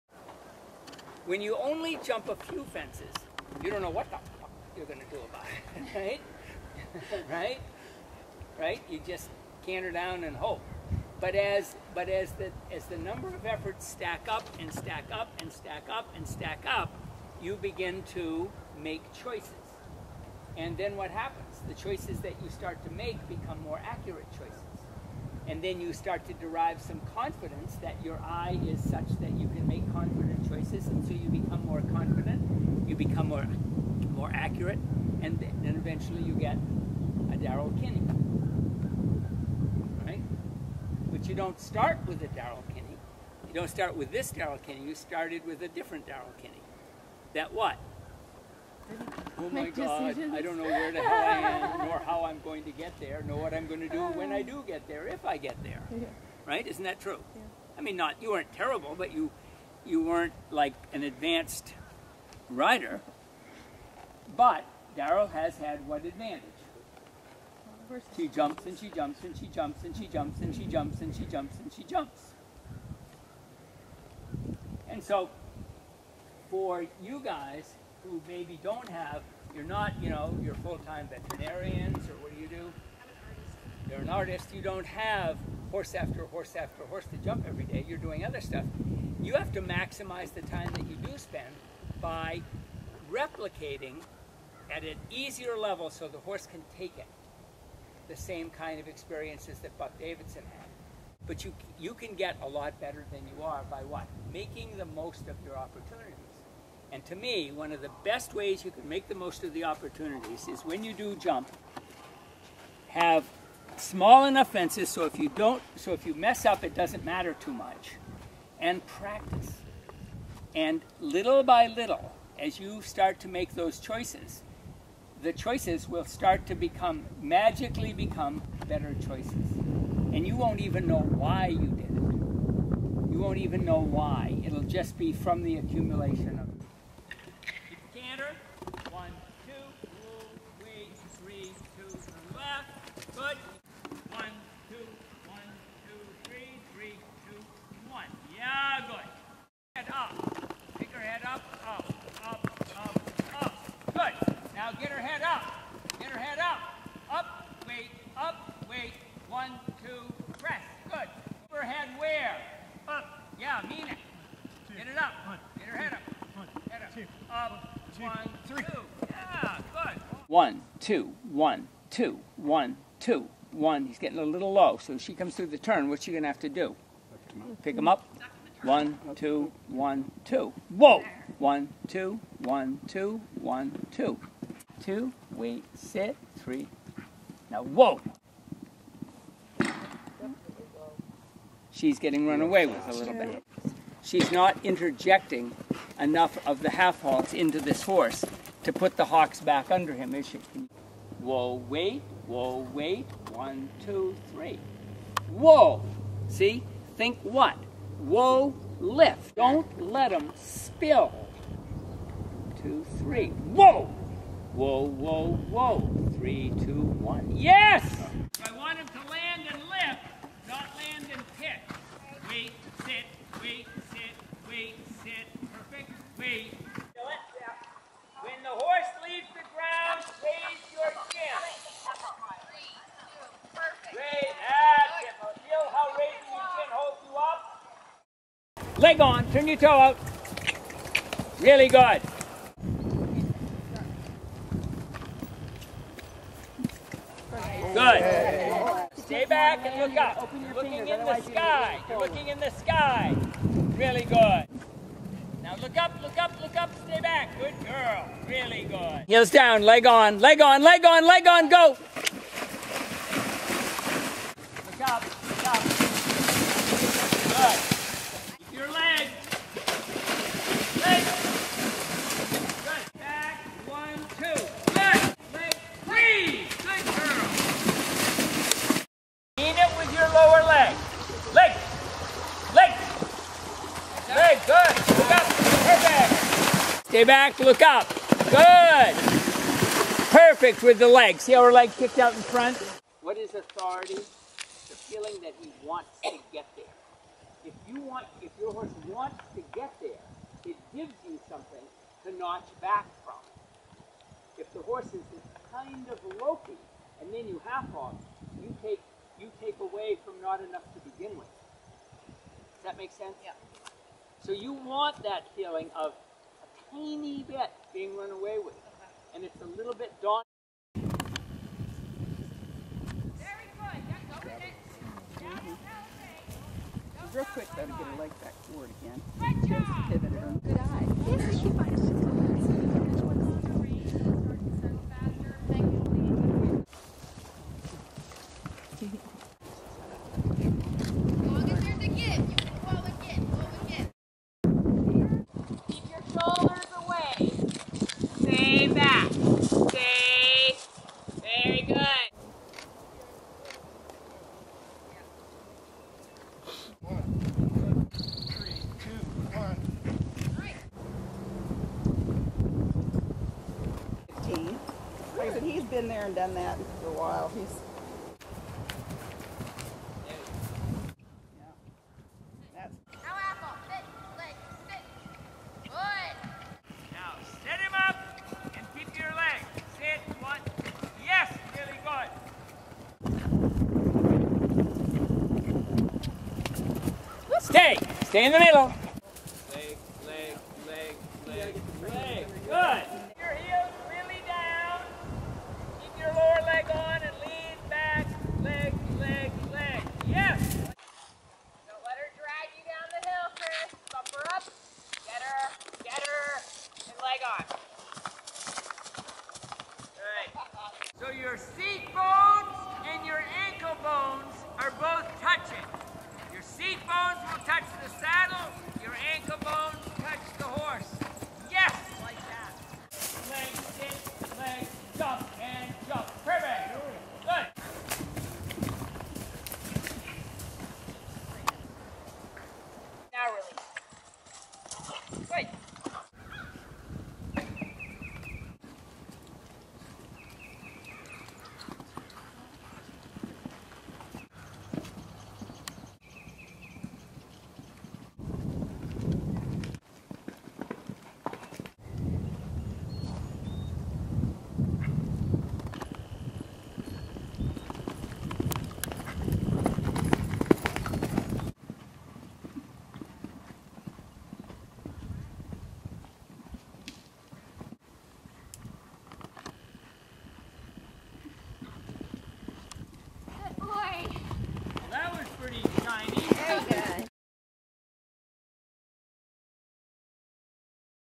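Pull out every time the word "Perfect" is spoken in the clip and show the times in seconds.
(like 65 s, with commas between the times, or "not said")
225 s, 290 s.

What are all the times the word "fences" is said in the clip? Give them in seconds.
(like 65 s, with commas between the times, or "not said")
2 s, 114 s.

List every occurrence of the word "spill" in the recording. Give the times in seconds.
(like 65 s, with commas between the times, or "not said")
210 s.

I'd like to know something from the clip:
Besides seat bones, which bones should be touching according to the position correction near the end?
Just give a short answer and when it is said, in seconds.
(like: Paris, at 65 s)
ankle bones, at 413 s.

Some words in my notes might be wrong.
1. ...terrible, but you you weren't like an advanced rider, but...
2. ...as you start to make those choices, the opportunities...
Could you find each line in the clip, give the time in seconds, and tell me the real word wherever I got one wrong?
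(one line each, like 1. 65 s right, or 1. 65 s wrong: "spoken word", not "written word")
1. 58 s right
2. 122 s wrong: "choices", not "opportunities".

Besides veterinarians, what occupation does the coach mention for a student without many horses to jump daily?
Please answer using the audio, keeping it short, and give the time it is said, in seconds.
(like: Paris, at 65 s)
artist, at 84 s.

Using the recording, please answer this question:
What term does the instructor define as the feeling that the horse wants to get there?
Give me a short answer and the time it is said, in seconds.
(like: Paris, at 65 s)
authority, at 293 s.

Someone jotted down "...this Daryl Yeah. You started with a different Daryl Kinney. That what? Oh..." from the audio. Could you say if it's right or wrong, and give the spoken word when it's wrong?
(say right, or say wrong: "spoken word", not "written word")
wrong: "Kinney", not "Yeah".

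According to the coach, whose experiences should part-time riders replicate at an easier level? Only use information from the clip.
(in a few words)
Buck Davidson.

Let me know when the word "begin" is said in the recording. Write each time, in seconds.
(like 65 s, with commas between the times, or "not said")
17 s, 310 s.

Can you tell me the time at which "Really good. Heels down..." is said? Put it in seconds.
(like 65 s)
258 s.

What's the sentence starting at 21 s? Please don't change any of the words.
The choices that you start to make become more accurate choices.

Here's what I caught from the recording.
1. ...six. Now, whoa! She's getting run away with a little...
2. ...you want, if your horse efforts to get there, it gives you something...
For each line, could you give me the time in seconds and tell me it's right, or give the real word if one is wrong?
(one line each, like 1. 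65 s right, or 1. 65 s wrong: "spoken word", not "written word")
1. 186 s wrong: "three", not "six"
2. 297 s wrong: "wants", not "efforts".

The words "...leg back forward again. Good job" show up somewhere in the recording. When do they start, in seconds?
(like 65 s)
327 s.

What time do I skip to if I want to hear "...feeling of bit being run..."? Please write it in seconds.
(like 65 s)
315 s.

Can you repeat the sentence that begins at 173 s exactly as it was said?
He's getting a little low, so she comes through the turn.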